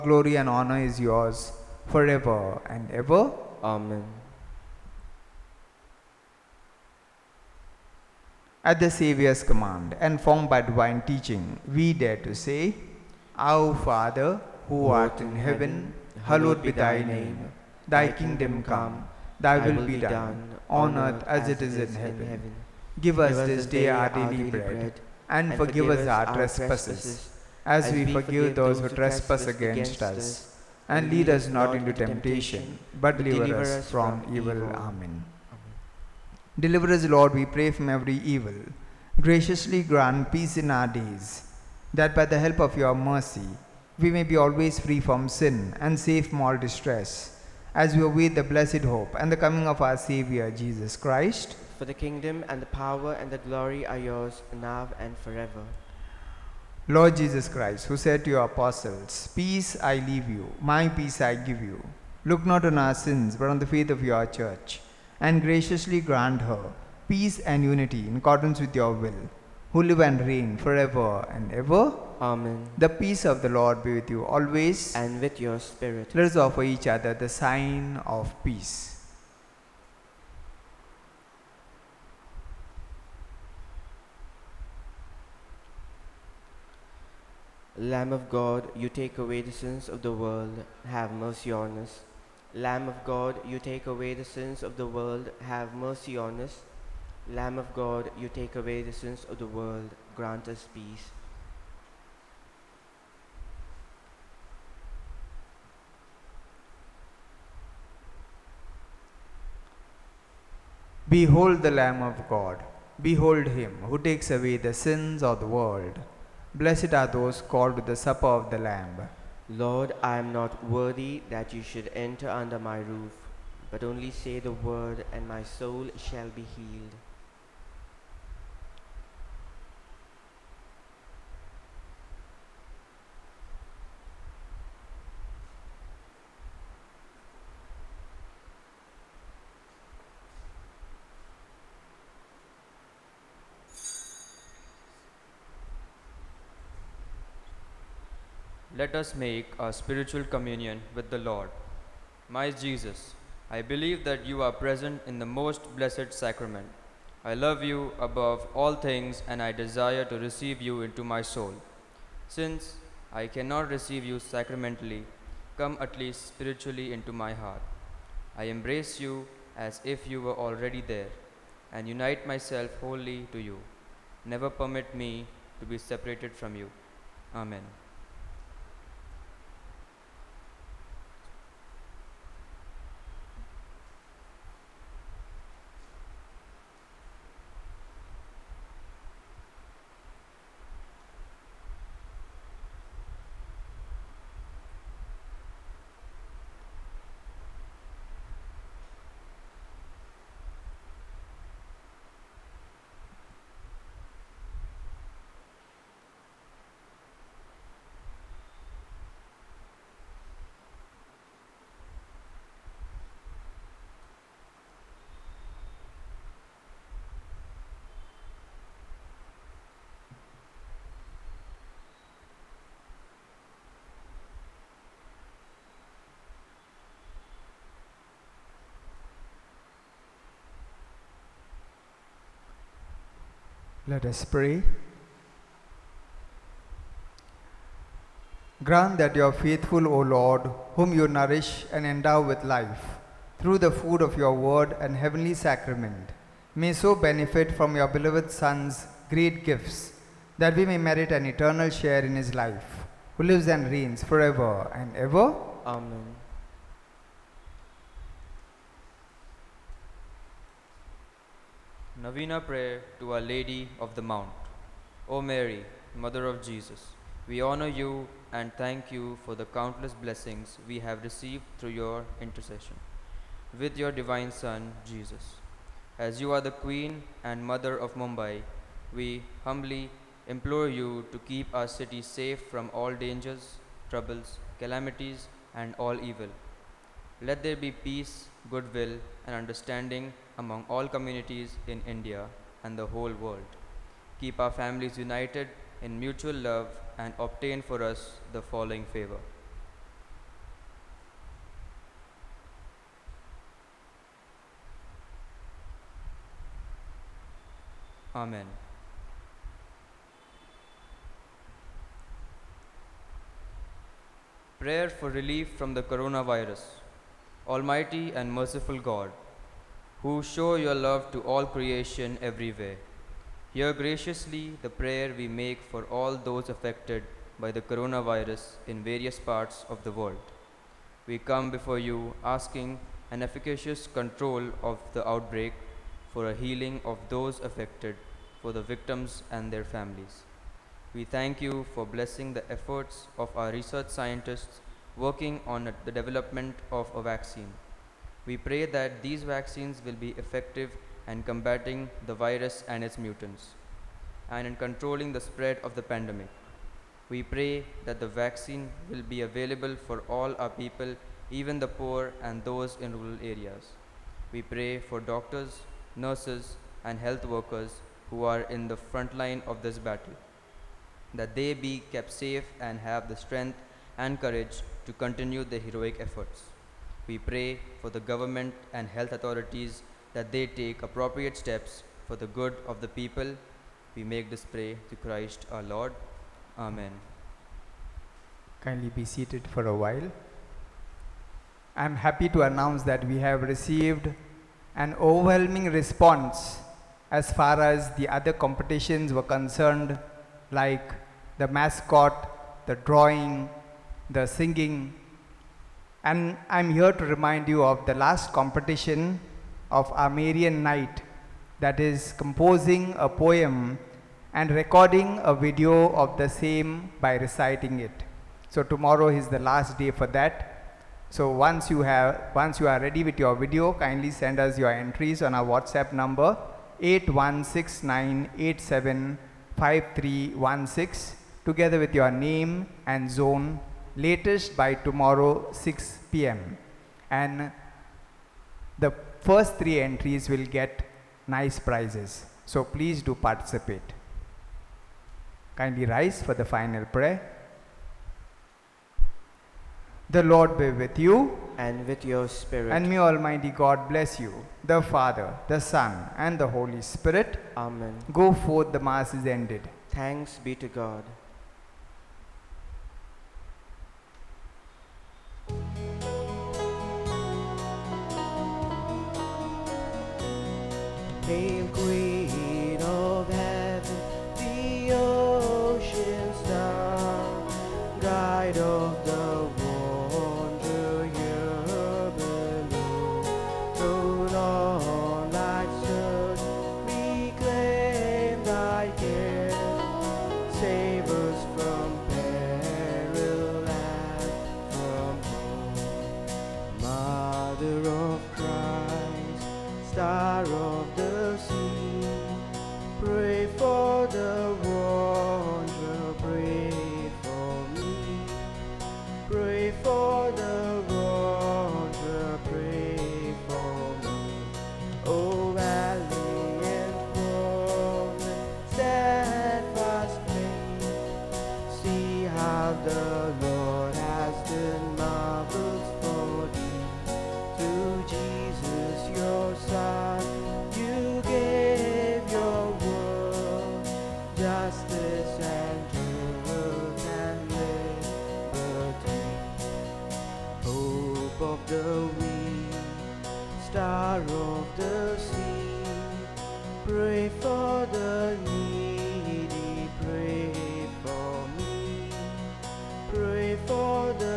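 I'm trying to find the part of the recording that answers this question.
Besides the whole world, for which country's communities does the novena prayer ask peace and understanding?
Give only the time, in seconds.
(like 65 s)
291 s.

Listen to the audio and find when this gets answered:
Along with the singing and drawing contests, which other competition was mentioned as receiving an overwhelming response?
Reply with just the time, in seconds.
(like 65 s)
401 s.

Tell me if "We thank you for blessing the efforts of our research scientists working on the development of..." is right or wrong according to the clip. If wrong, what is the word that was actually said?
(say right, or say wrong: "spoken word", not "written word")
right.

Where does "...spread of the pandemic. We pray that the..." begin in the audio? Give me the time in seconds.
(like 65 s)
355 s.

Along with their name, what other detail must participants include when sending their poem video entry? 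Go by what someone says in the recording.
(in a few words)
zone.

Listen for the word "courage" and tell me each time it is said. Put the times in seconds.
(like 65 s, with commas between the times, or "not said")
374 s.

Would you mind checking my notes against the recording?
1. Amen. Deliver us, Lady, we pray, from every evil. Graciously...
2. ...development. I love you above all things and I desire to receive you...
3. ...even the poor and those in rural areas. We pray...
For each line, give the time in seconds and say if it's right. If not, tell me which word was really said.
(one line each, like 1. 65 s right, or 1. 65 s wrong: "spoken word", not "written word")
1. 34 s wrong: "Lord", not "Lady"
2. 156 s wrong: "sacrament", not "development"
3. 361 s right.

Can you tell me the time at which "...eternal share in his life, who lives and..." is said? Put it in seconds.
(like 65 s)
251 s.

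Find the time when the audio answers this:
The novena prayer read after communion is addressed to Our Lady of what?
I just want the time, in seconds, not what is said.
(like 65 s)
263 s.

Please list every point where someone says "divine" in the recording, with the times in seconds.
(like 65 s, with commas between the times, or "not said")
10 s, 273 s.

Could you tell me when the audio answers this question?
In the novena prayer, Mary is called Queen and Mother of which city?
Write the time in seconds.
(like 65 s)
277 s.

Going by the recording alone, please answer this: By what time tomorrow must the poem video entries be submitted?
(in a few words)
6 p.m.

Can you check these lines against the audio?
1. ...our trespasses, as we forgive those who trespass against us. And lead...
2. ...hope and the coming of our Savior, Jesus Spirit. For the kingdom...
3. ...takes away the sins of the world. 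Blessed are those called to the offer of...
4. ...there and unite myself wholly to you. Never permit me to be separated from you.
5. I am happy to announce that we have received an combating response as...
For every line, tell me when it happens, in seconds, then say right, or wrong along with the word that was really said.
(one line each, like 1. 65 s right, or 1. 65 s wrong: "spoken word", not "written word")
1. 26 s right
2. 48 s wrong: "Christ", not "Spirit"
3. 114 s wrong: "supper", not "offer"
4. 170 s right
5. 391 s wrong: "overwhelming", not "combating".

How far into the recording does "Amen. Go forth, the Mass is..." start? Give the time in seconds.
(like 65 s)
457 s.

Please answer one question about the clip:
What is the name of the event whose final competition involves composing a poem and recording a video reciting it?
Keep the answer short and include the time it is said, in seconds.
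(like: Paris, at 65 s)
Marian Night, at 410 s.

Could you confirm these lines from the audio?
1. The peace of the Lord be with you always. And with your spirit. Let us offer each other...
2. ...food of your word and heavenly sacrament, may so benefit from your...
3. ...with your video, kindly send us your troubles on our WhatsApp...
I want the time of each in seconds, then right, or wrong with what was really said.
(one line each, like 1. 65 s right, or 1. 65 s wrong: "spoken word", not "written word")
1. 72 s right
2. 243 s right
3. 423 s wrong: "entries", not "troubles".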